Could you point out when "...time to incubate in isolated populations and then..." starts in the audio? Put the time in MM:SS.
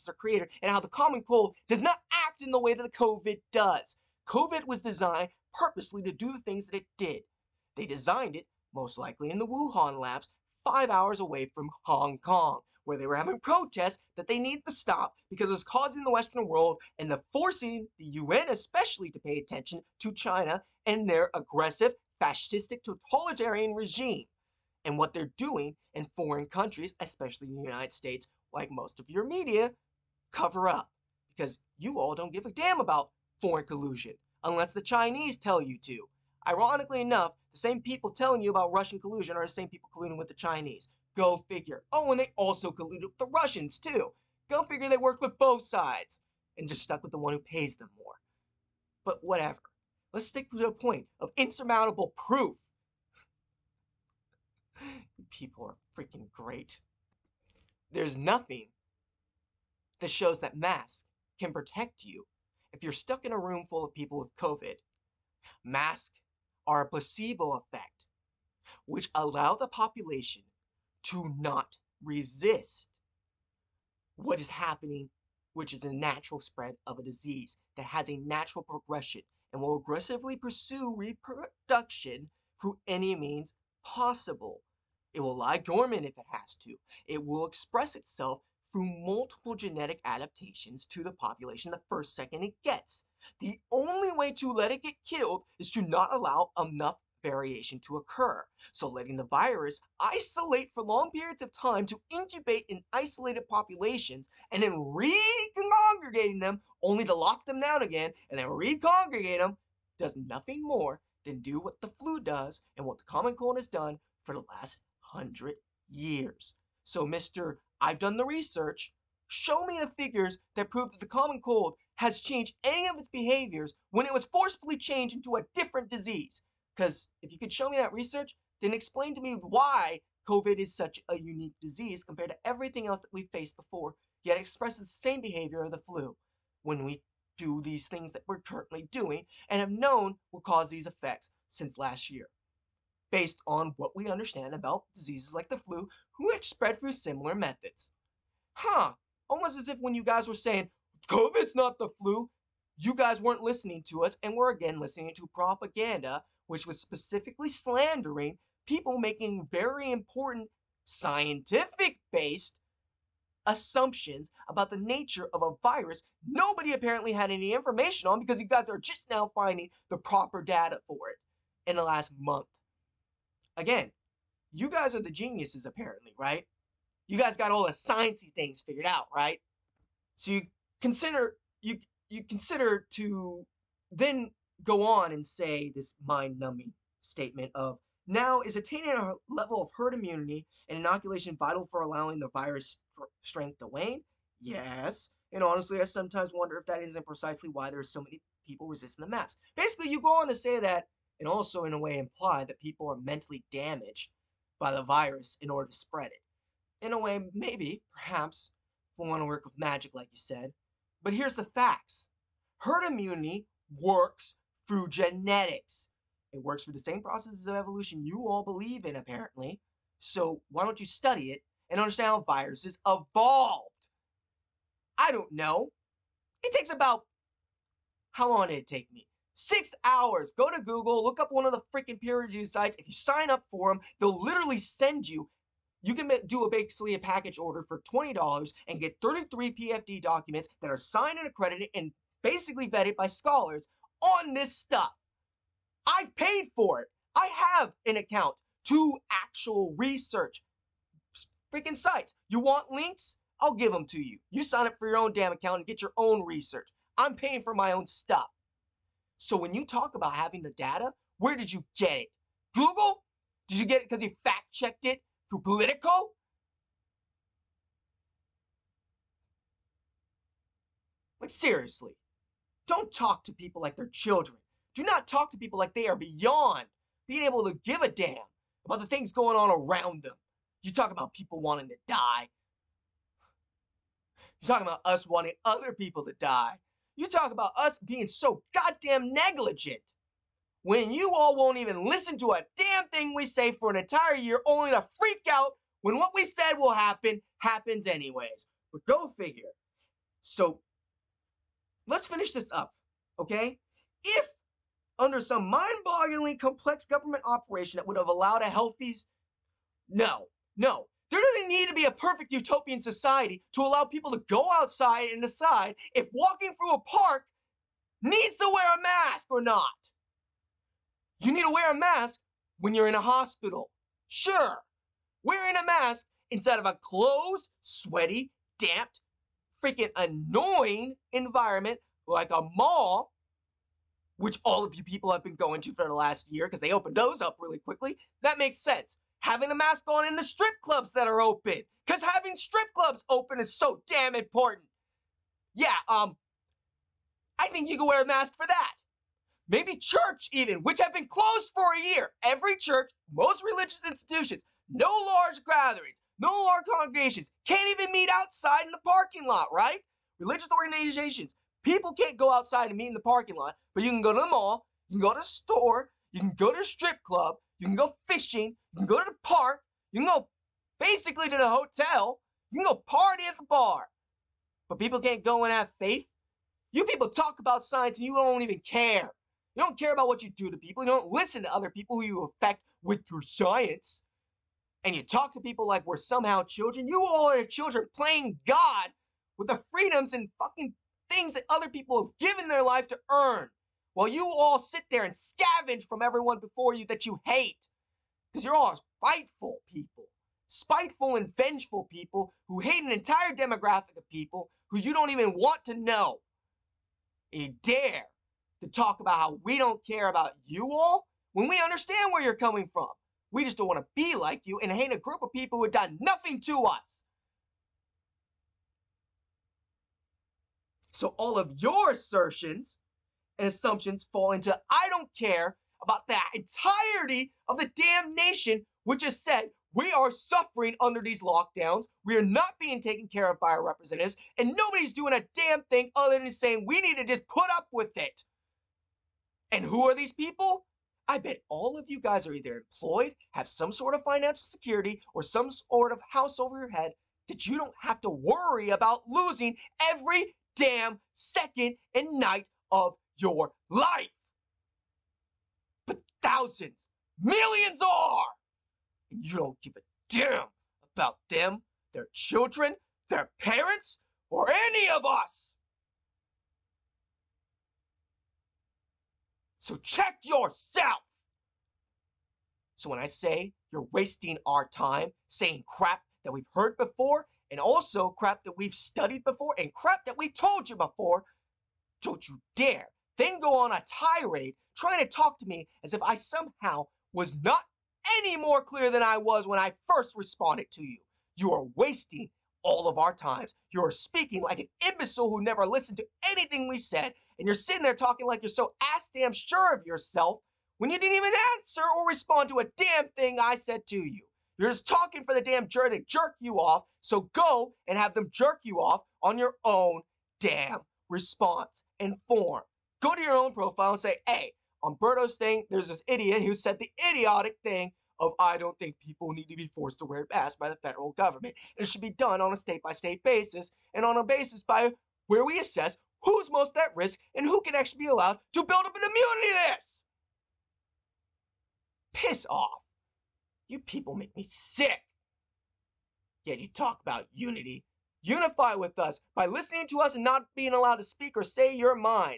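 01:41.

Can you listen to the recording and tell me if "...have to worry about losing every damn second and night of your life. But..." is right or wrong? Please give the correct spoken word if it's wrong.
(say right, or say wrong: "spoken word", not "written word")
right.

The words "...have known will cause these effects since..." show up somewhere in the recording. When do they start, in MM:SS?
02:19.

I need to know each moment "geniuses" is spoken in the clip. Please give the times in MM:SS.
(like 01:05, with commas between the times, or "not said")
02:55.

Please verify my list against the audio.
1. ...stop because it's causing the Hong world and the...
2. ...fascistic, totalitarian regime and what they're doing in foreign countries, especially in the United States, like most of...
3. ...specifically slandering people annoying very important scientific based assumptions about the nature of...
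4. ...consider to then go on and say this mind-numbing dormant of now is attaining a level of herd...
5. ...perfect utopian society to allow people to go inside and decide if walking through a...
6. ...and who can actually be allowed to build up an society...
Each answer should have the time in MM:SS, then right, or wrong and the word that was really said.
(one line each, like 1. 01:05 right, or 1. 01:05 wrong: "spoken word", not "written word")
1. 00:14 wrong: "Western", not "Hong"
2. 00:22 right
3. 02:36 wrong: "making", not "annoying"
4. 03:02 wrong: "statement", not "dormant"
5. 05:11 wrong: "outside", not "inside"
6. 08:47 wrong: "immunity", not "society".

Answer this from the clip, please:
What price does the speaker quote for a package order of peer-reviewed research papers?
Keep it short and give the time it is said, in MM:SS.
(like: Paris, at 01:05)
$20, at 03:57.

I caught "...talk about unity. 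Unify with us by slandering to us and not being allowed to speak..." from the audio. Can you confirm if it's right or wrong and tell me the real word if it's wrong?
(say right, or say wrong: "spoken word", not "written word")
wrong: "listening", not "slandering".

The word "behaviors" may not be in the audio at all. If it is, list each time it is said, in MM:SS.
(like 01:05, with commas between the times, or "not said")
02:03, 02:15.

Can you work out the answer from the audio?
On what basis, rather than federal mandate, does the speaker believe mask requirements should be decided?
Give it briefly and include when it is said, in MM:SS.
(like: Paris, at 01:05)
state by state, at 08:42.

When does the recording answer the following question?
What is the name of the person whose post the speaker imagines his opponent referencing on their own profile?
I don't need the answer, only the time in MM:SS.
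08:34.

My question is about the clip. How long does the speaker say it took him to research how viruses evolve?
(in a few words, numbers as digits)
6 hours.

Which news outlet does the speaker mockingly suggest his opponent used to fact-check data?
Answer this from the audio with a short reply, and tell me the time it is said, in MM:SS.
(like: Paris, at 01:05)
Politico, at 04:25.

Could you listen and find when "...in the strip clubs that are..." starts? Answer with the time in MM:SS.
05:40.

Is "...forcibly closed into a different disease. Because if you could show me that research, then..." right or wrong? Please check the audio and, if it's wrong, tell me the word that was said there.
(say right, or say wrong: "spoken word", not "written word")
wrong: "changed", not "closed".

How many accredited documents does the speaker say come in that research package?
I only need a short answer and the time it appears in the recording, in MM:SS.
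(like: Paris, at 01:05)
33, at 03:59.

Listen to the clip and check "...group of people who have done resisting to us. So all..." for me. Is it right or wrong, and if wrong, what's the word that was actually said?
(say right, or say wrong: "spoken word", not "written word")
wrong: "nothing", not "resisting".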